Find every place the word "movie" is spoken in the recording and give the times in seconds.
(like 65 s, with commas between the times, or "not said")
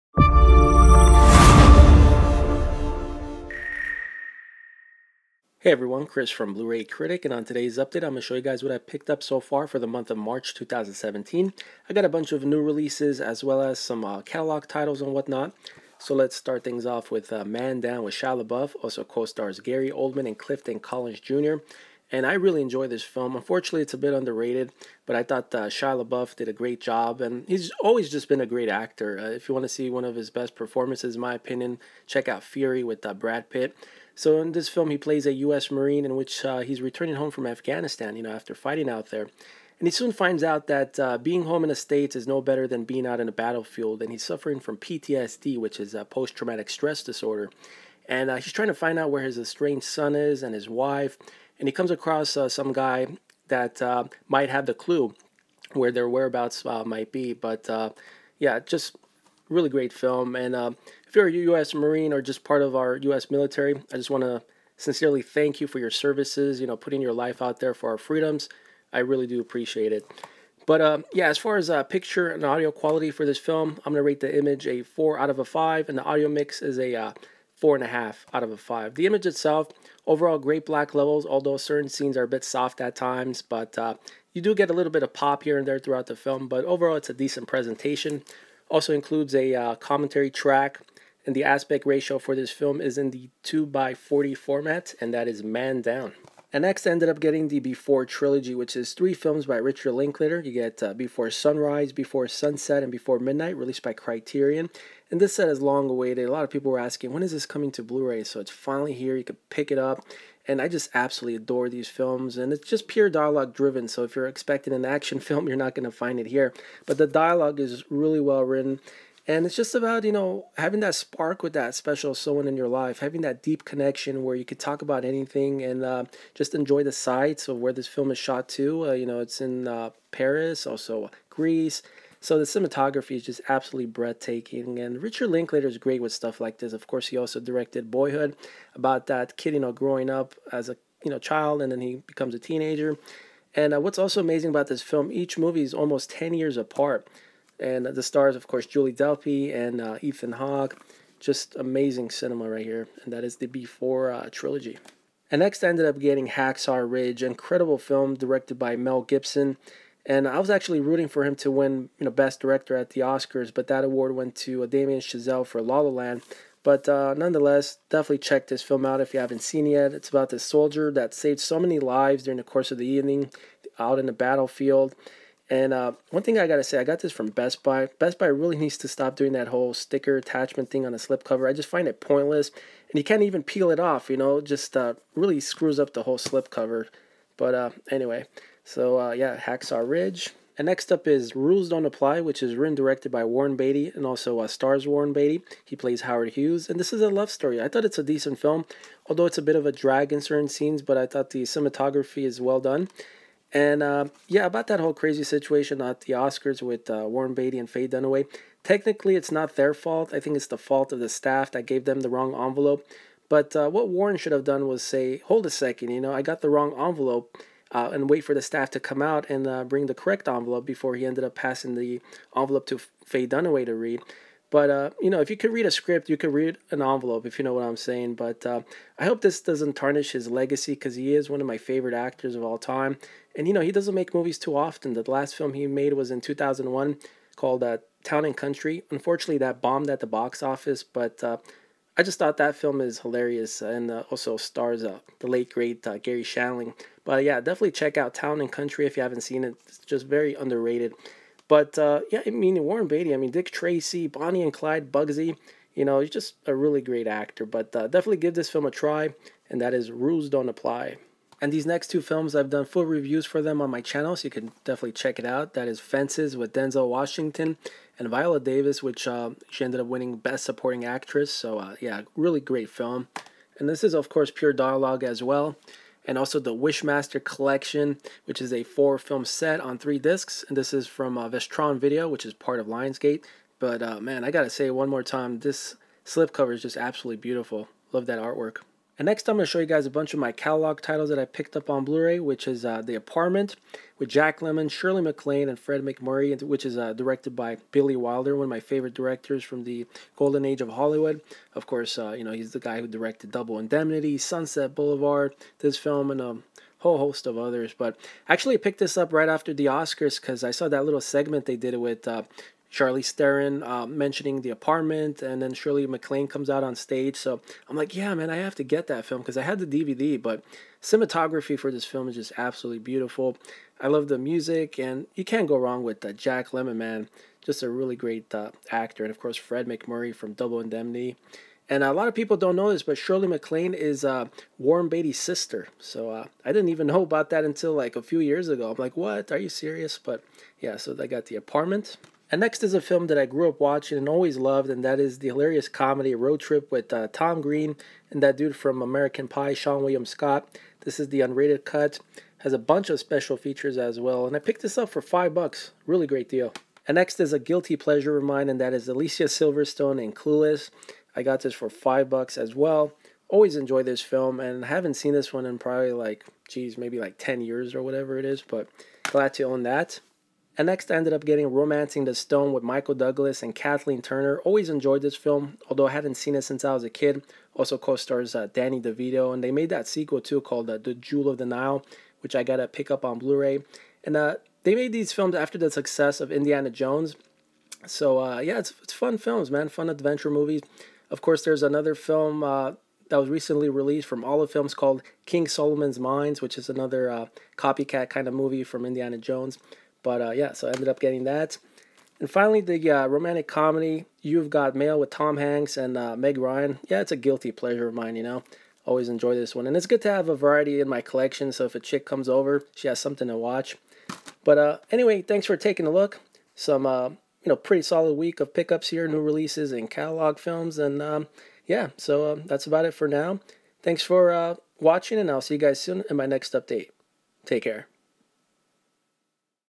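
145 s, 234 s, 390 s, 398 s.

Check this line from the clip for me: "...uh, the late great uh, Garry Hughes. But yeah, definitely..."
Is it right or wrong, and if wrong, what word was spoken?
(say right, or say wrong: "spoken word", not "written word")
wrong: "Shandling", not "Hughes".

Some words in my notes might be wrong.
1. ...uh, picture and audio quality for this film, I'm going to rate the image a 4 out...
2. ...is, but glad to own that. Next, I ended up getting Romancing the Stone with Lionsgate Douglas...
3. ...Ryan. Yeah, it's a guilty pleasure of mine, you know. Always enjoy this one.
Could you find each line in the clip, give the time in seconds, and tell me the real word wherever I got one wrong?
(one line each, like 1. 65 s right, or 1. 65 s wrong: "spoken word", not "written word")
1. 71 s right
2. 368 s wrong: "Michael", not "Lionsgate"
3. 406 s right.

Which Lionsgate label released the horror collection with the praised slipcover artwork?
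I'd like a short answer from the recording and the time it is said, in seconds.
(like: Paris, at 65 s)
Vestron Video, at 281 s.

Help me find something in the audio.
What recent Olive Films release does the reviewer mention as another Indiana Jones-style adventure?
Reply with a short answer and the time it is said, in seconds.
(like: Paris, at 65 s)
King Solomon's Mines, at 395 s.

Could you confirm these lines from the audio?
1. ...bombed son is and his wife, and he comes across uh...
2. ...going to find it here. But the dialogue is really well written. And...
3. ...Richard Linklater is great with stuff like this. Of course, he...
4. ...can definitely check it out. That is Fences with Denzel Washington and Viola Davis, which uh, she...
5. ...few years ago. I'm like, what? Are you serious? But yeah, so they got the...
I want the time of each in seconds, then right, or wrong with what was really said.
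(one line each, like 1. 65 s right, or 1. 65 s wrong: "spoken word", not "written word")
1. 49 s wrong: "estranged", not "bombed"
2. 115 s right
3. 135 s right
4. 264 s right
5. 338 s right.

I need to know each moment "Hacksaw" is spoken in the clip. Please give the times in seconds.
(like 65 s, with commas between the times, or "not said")
156 s, 189 s.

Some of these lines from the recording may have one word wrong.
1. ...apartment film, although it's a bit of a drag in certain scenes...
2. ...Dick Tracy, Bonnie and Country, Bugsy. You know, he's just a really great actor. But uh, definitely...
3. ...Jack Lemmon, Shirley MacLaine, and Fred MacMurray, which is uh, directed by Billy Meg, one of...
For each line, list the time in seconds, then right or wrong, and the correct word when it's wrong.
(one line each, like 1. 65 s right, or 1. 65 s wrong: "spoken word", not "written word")
1. 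198 s wrong: "decent", not "apartment"
2. 253 s wrong: "Clyde", not "Country"
3. 294 s wrong: "Wilder", not "Meg".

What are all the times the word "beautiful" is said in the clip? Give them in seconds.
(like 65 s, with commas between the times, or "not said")
287 s, 322 s.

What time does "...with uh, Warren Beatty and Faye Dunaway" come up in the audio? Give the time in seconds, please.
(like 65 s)
206 s.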